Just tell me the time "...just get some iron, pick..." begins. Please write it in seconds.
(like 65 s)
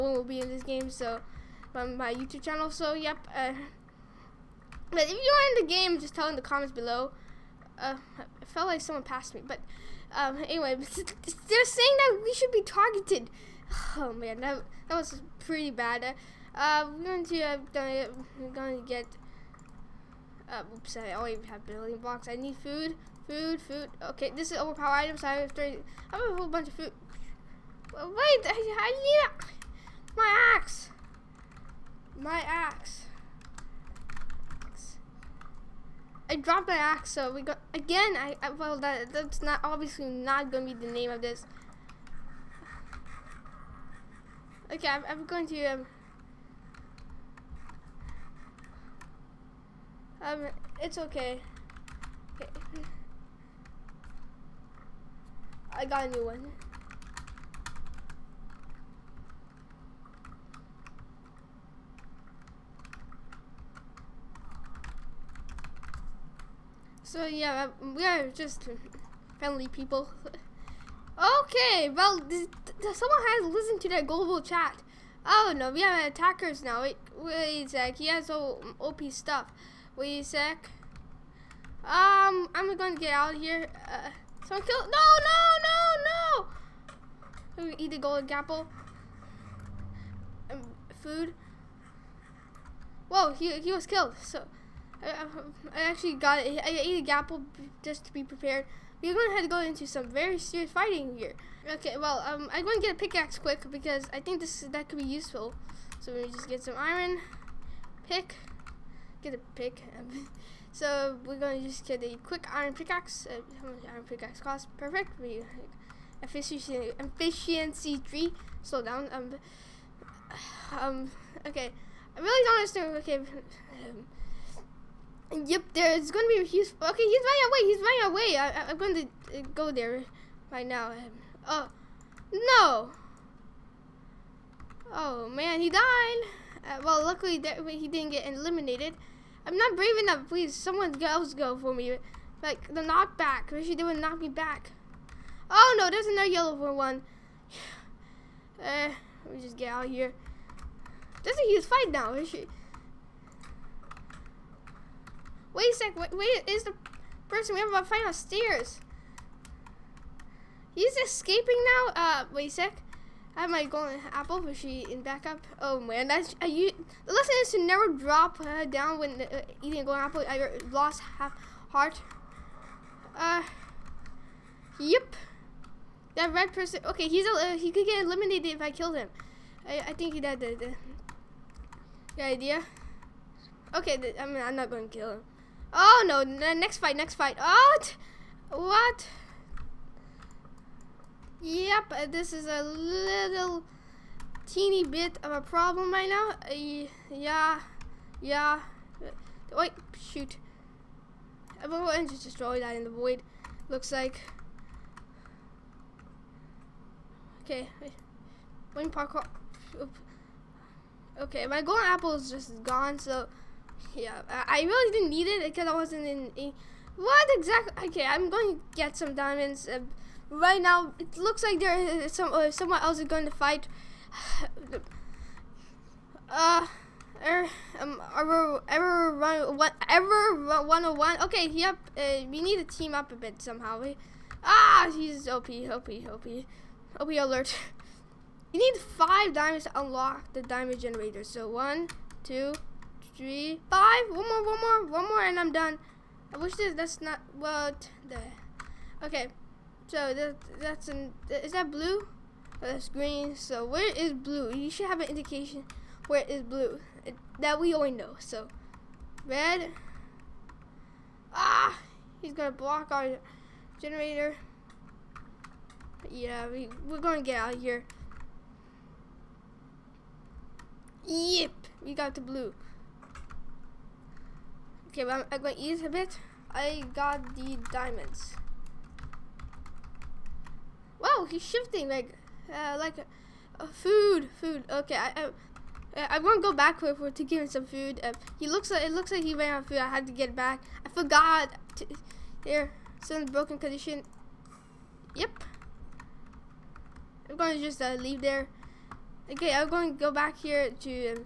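106 s.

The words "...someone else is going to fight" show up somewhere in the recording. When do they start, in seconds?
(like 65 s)
222 s.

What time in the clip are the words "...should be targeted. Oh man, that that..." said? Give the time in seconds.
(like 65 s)
12 s.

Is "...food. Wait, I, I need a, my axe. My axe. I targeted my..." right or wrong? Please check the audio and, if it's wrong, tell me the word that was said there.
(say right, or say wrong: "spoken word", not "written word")
wrong: "dropped", not "targeted".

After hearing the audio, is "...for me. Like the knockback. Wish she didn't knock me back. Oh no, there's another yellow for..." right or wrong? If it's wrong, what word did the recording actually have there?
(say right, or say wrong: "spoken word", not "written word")
right.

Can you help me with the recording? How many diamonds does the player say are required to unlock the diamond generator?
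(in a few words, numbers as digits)
5.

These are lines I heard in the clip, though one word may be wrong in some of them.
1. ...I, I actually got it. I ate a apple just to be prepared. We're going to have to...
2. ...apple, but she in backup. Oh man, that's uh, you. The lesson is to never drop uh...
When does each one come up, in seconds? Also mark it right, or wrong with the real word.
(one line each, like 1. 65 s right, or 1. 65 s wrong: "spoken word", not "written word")
1. 95 s right
2. 164 s right.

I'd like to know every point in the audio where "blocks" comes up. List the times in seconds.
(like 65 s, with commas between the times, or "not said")
21 s, 262 s.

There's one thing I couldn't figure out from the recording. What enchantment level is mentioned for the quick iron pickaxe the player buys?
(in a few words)
Efficiency 3.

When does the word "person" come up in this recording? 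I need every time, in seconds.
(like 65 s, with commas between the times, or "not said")
157 s, 176 s.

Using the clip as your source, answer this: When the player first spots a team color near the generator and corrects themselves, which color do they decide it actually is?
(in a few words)
green.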